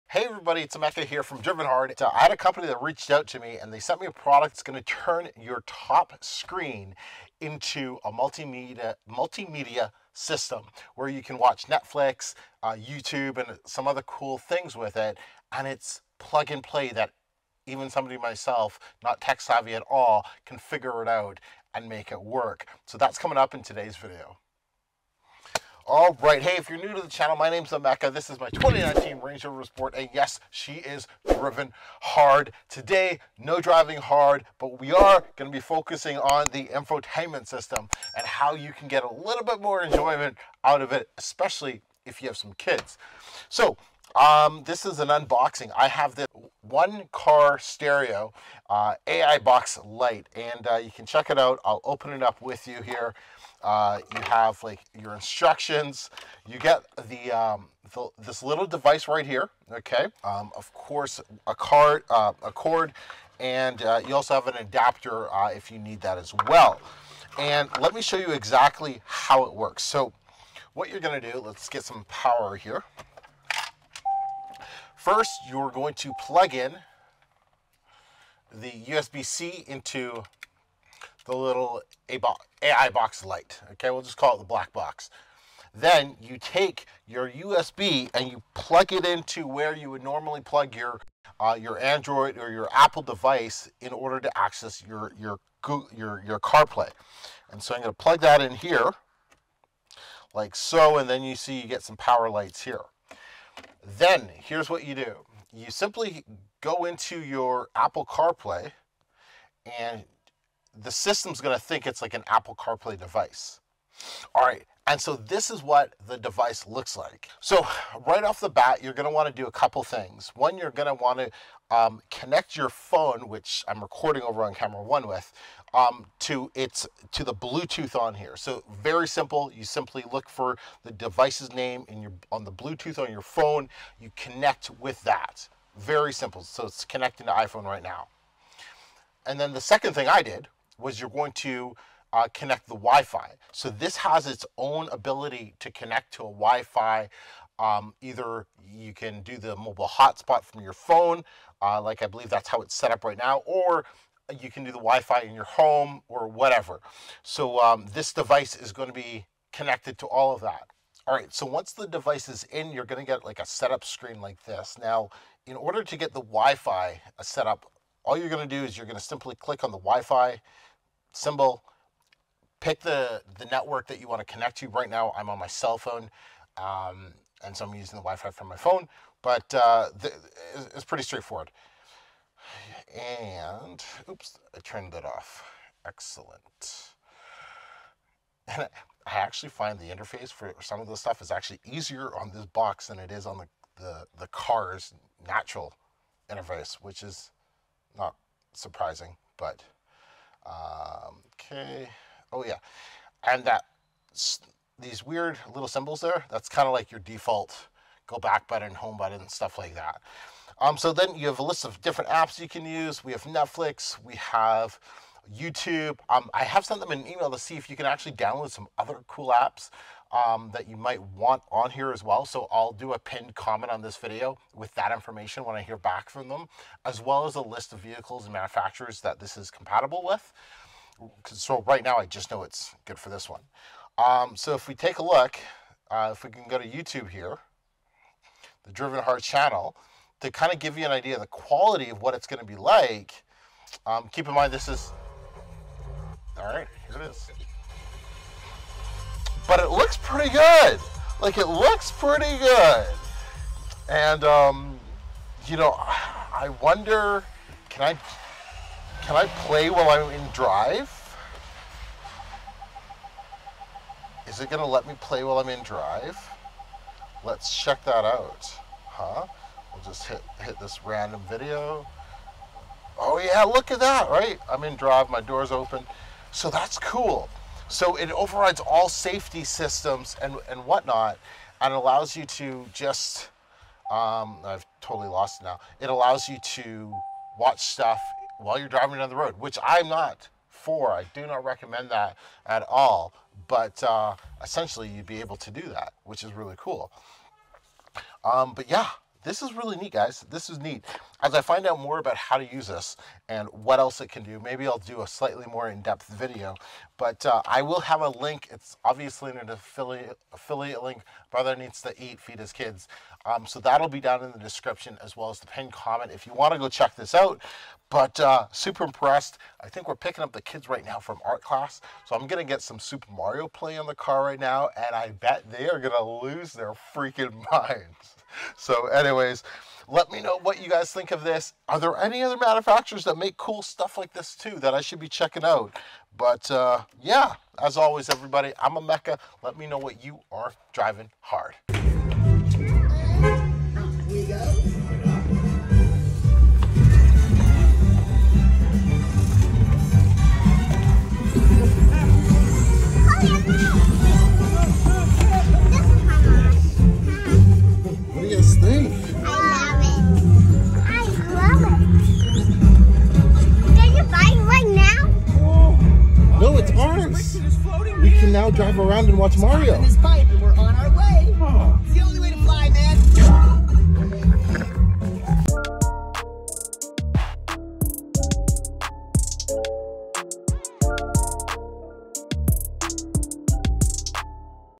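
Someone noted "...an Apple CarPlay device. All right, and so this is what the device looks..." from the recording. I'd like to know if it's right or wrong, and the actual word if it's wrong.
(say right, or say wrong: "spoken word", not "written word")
right.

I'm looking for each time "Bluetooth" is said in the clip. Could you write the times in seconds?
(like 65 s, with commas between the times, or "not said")
127 s, 132 s.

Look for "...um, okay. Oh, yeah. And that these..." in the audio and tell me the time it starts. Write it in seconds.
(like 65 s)
200 s.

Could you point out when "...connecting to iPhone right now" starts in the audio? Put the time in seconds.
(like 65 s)
136 s.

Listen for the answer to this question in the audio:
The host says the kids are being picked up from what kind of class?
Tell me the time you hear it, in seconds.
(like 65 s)
321 s.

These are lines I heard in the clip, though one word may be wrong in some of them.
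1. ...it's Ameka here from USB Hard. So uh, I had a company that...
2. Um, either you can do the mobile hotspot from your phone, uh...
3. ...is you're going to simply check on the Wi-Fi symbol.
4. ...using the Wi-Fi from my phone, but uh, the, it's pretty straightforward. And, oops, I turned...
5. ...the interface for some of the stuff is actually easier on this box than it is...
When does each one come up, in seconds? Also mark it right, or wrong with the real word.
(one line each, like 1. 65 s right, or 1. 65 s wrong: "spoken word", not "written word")
1. 0 s wrong: "Driven", not "USB"
2. 147 s right
3. 168 s wrong: "click", not "check"
4. 177 s right
5. 189 s right.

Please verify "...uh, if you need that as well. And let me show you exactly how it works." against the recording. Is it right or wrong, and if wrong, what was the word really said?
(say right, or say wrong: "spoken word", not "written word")
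right.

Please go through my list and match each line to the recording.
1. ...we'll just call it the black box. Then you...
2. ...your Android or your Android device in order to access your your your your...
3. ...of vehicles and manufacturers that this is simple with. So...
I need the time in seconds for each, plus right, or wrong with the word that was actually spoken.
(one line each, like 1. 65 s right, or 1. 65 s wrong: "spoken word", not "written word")
1. 83 s right
2. 91 s wrong: "Apple", not "Android"
3. 227 s wrong: "compatible", not "simple".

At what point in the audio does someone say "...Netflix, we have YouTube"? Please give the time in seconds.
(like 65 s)
213 s.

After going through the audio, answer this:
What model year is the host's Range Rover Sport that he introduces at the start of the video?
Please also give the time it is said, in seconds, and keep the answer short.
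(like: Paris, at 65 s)
2019, at 28 s.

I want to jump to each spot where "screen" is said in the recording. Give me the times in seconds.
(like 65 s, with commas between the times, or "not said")
6 s, 163 s.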